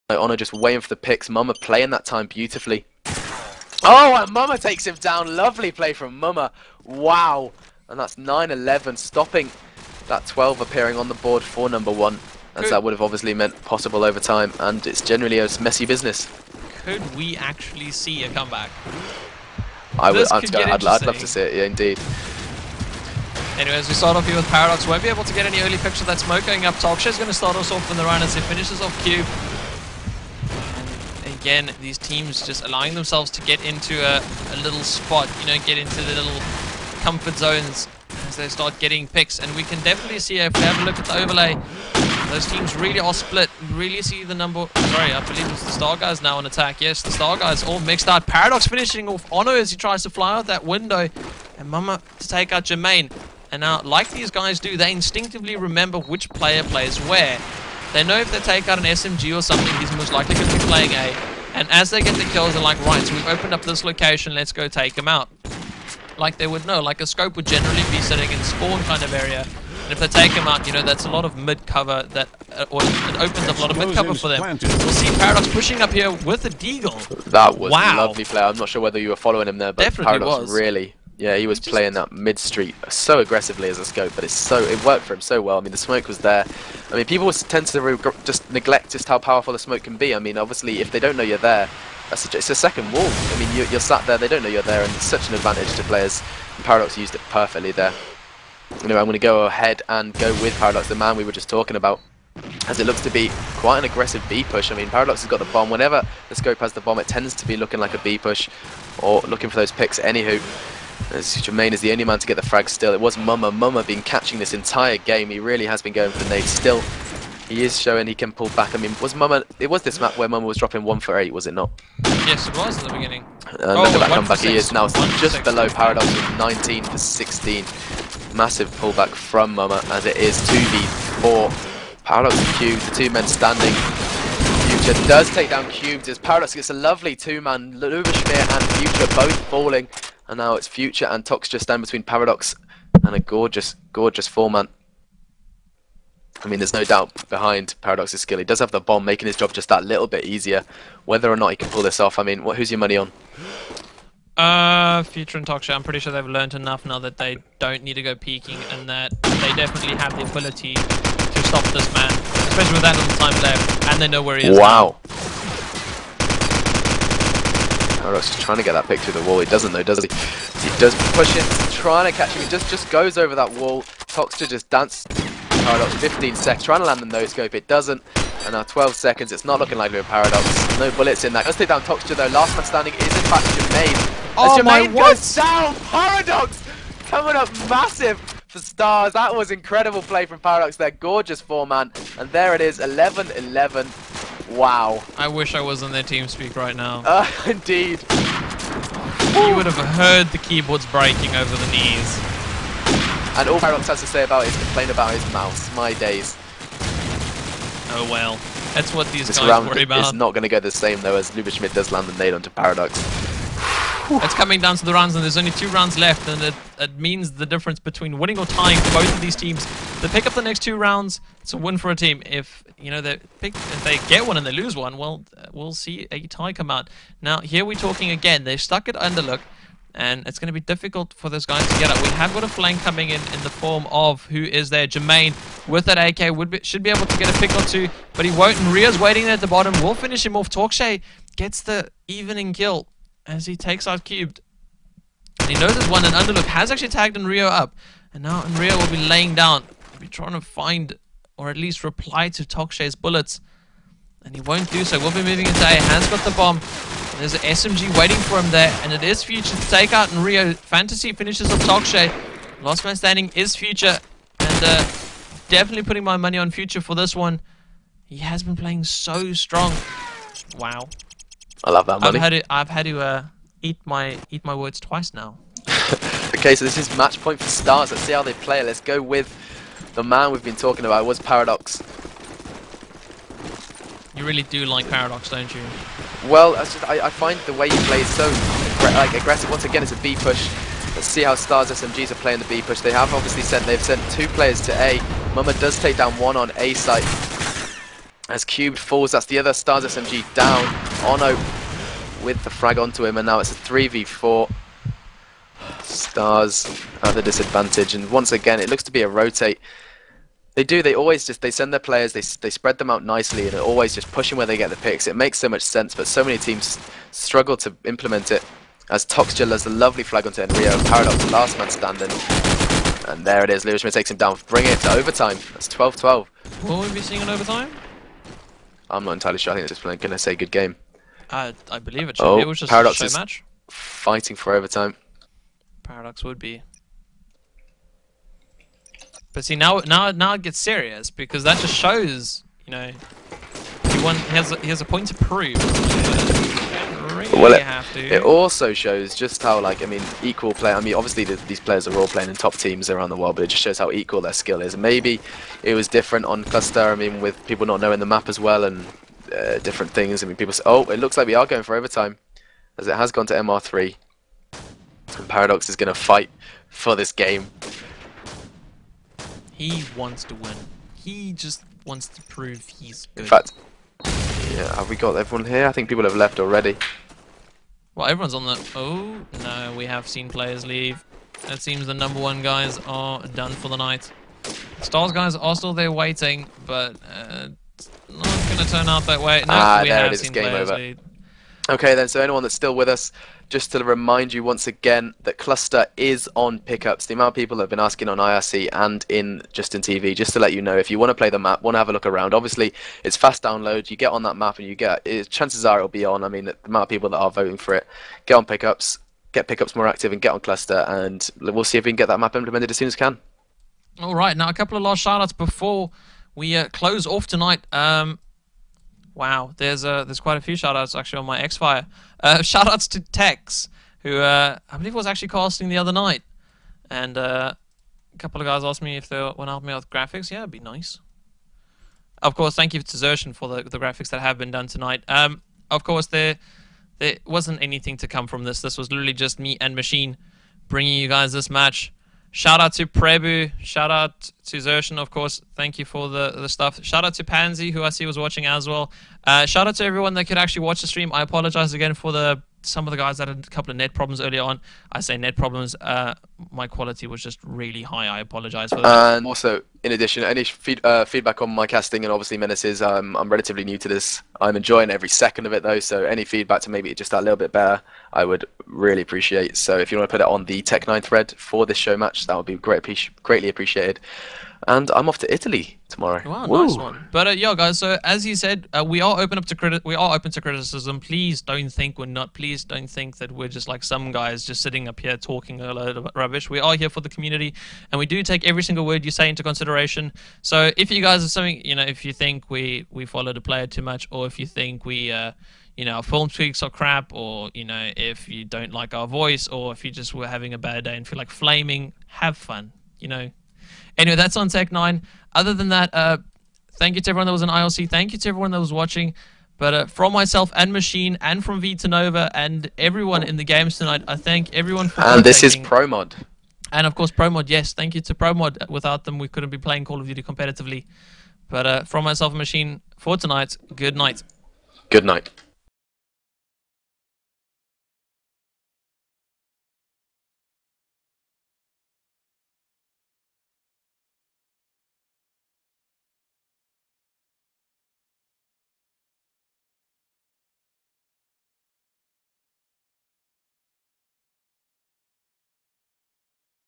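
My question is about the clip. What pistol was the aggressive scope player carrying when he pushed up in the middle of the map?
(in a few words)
Deagle.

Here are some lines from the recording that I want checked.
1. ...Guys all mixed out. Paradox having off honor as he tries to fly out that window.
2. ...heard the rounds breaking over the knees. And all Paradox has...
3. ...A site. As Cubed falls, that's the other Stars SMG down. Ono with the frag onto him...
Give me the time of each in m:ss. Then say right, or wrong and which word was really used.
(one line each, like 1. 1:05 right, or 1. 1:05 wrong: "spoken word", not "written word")
1. 0:47 wrong: "finishing", not "having"
2. 3:19 wrong: "keyboards", not "rounds"
3. 4:56 right.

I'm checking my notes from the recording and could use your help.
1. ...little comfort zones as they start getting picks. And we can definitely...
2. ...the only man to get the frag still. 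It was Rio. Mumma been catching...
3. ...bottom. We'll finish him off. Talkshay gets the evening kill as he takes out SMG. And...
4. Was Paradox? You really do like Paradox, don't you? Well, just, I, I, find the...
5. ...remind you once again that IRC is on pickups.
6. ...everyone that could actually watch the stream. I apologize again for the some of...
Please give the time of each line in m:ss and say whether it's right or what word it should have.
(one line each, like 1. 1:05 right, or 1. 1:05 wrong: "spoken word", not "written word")
1. 0:36 right
2. 1:51 wrong: "Mumma", not "Rio"
3. 3:59 wrong: "Cubed", not "SMG"
4. 4:41 right
5. 6:33 wrong: "Cluster", not "IRC"
6. 7:29 right.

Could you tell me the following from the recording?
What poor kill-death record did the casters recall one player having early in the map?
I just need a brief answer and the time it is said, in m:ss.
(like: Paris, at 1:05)
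1 for 8, at 2:00.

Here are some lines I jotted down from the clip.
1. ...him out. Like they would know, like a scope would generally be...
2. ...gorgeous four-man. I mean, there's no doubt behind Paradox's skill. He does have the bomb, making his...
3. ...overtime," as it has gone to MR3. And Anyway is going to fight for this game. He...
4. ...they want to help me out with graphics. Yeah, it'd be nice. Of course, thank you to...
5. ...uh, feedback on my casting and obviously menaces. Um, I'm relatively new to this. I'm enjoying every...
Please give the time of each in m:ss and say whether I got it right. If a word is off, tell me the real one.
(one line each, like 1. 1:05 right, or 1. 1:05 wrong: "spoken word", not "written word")
1. 1:04 right
2. 2:23 right
3. 6:01 wrong: "Paradox", not "Anyway"
4. 7:09 right
5. 7:40 right.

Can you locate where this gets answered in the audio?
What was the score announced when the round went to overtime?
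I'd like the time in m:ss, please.
5:25.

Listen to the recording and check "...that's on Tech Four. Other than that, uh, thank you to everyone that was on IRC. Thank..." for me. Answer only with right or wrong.
wrong.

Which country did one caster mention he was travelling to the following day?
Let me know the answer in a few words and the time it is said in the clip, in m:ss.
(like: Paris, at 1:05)
Italy, at 7:55.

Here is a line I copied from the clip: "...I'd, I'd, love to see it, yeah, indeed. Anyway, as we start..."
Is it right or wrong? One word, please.
right.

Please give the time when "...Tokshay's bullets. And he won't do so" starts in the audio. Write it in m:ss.
4:12.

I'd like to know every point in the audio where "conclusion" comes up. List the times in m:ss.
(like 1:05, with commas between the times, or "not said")
not said.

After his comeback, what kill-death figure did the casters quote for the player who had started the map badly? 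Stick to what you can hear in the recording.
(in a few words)
19 for 16.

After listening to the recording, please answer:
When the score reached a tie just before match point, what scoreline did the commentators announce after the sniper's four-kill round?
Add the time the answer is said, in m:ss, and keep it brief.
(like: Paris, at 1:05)
11-11, at 3:12.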